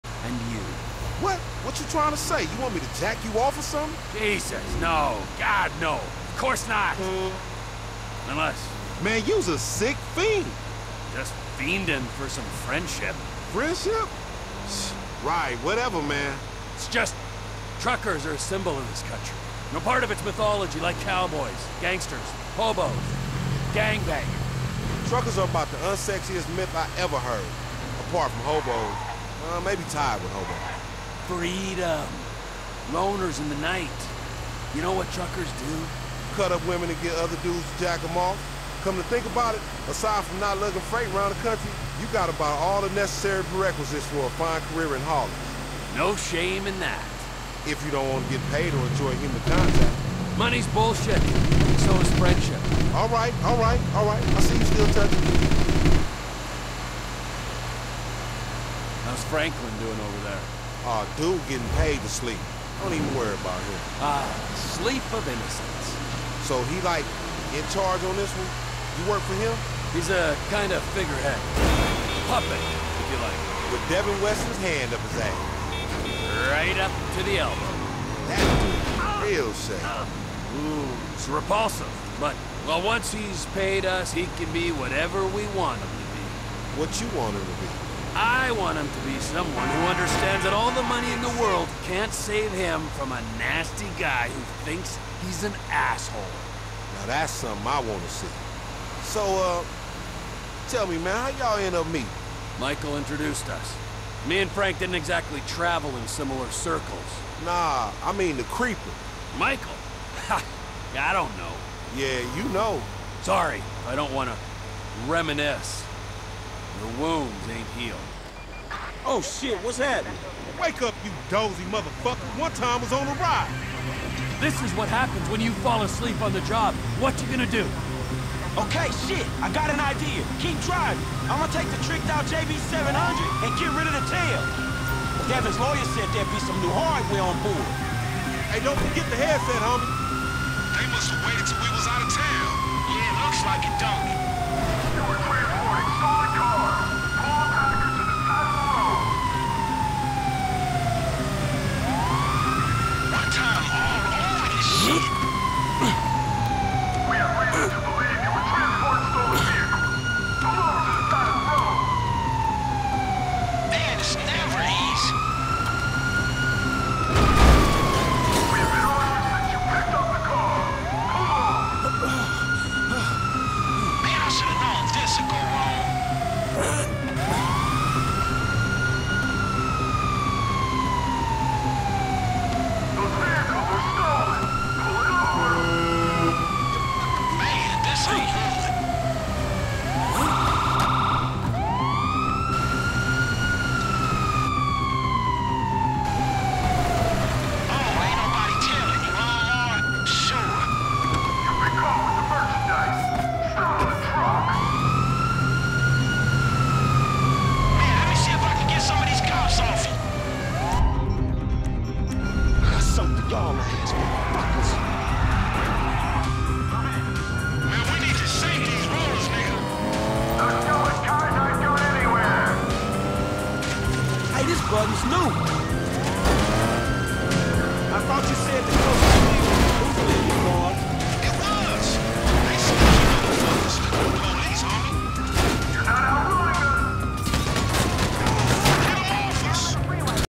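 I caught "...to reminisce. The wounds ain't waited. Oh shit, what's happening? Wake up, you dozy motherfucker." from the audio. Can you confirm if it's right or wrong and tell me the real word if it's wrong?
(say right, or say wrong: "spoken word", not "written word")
wrong: "healed", not "waited".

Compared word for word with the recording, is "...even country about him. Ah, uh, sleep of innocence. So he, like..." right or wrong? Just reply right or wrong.
wrong.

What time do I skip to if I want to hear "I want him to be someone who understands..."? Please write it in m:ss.
1:28.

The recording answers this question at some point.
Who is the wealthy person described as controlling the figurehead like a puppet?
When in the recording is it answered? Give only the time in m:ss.
1:13.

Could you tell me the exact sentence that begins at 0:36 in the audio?
Cut up women and get other dudes to jack them off.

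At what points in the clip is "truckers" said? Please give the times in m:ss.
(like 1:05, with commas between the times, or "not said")
0:17, 0:25, 0:35.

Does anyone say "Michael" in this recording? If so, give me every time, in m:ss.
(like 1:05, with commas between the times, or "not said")
1:42, 1:49.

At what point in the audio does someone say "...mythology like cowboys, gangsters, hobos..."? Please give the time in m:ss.
0:20.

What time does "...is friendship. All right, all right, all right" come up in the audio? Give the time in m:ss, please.
0:52.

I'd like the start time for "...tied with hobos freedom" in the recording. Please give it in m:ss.
0:29.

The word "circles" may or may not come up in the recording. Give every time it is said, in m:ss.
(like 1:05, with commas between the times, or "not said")
1:46.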